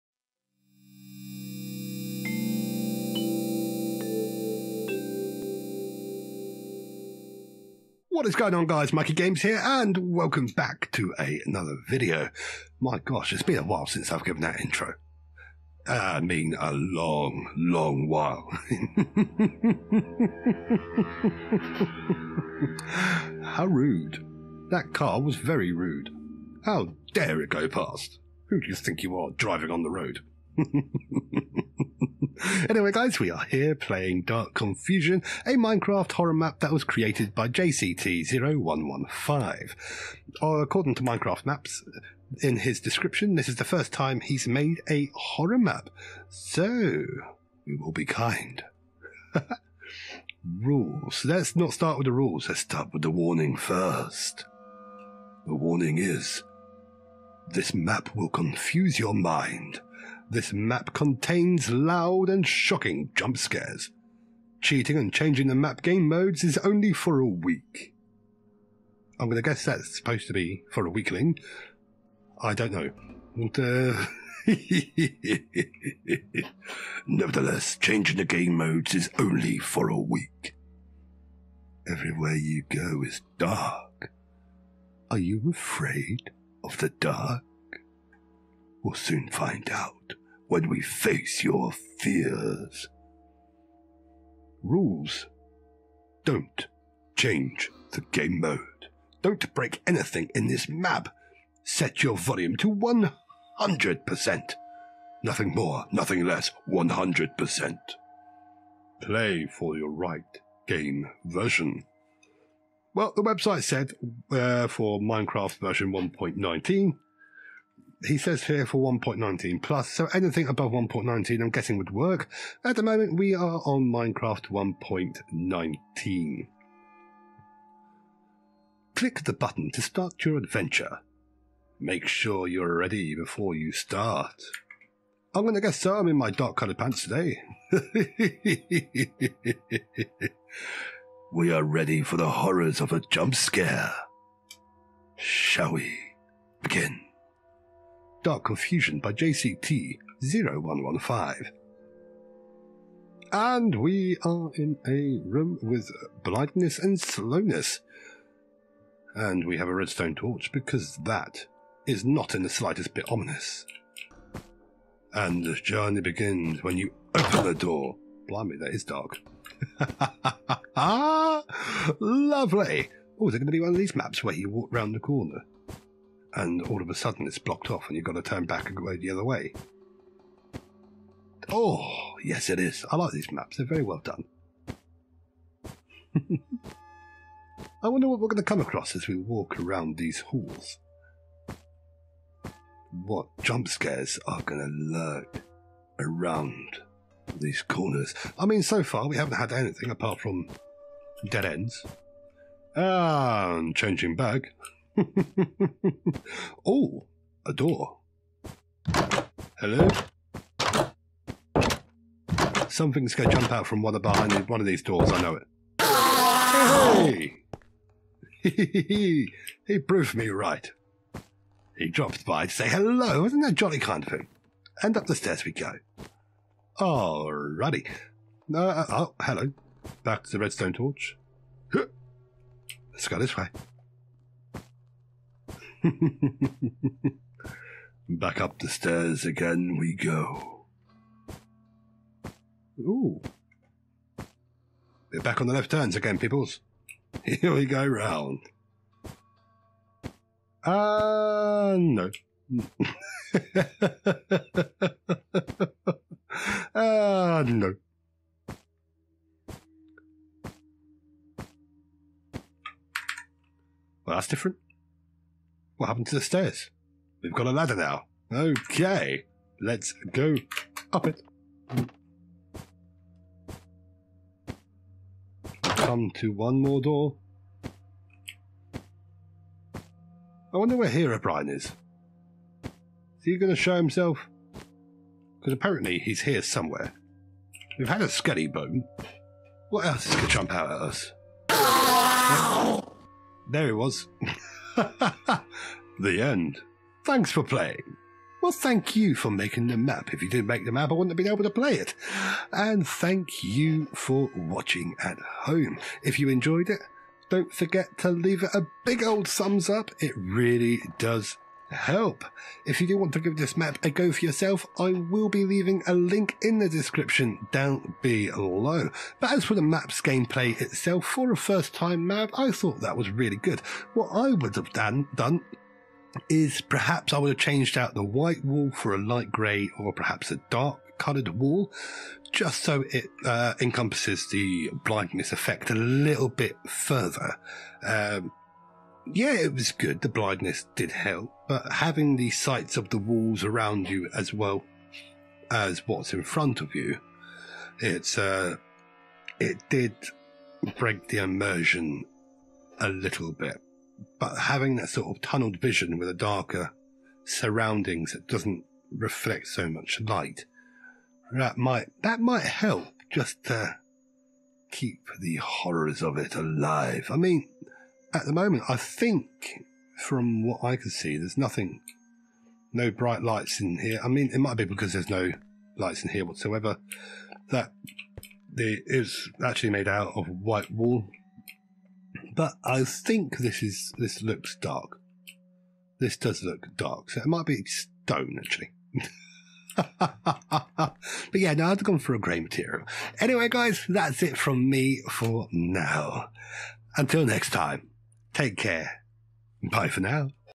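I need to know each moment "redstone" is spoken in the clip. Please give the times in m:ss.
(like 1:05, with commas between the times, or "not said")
2:39, 3:50.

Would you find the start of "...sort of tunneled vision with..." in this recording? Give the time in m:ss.
5:54.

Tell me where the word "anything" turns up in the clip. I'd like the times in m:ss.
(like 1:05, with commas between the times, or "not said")
1:39, 2:00, 3:19.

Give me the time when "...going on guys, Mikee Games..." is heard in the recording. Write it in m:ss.
0:08.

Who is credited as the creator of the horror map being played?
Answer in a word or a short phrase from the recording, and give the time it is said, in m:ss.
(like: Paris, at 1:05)
JCT0115, at 0:37.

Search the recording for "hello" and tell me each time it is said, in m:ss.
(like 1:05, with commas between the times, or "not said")
3:29, 3:42, 3:49.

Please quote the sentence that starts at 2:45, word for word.
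And the journey begins when you open the door.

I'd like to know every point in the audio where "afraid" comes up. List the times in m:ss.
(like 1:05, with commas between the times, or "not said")
1:25.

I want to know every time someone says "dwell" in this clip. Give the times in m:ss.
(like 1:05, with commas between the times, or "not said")
not said.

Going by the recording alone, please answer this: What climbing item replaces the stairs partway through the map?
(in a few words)
A ladder.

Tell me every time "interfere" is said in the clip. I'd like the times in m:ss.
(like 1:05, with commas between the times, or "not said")
not said.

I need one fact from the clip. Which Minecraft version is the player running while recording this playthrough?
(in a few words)
1.19.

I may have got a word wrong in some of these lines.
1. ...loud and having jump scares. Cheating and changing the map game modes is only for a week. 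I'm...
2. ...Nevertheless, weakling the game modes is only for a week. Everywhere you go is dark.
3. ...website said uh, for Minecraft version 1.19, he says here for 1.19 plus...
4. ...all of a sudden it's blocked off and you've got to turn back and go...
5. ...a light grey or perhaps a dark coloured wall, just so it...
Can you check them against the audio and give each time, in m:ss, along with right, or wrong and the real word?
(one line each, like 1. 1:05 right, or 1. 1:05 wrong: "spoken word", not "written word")
1. 1:01 wrong: "shocking", not "having"
2. 1:17 wrong: "changing", not "weakling"
3. 1:53 right
4. 2:56 right
5. 5:28 right.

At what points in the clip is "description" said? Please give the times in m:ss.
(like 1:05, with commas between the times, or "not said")
0:42, 5:16.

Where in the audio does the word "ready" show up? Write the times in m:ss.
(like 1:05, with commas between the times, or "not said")
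2:12, 2:21.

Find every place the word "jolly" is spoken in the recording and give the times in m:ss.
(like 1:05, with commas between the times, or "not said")
3:43.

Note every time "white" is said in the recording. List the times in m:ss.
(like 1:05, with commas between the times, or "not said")
5:28, 6:20.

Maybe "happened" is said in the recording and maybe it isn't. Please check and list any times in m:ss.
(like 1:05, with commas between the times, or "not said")
4:25.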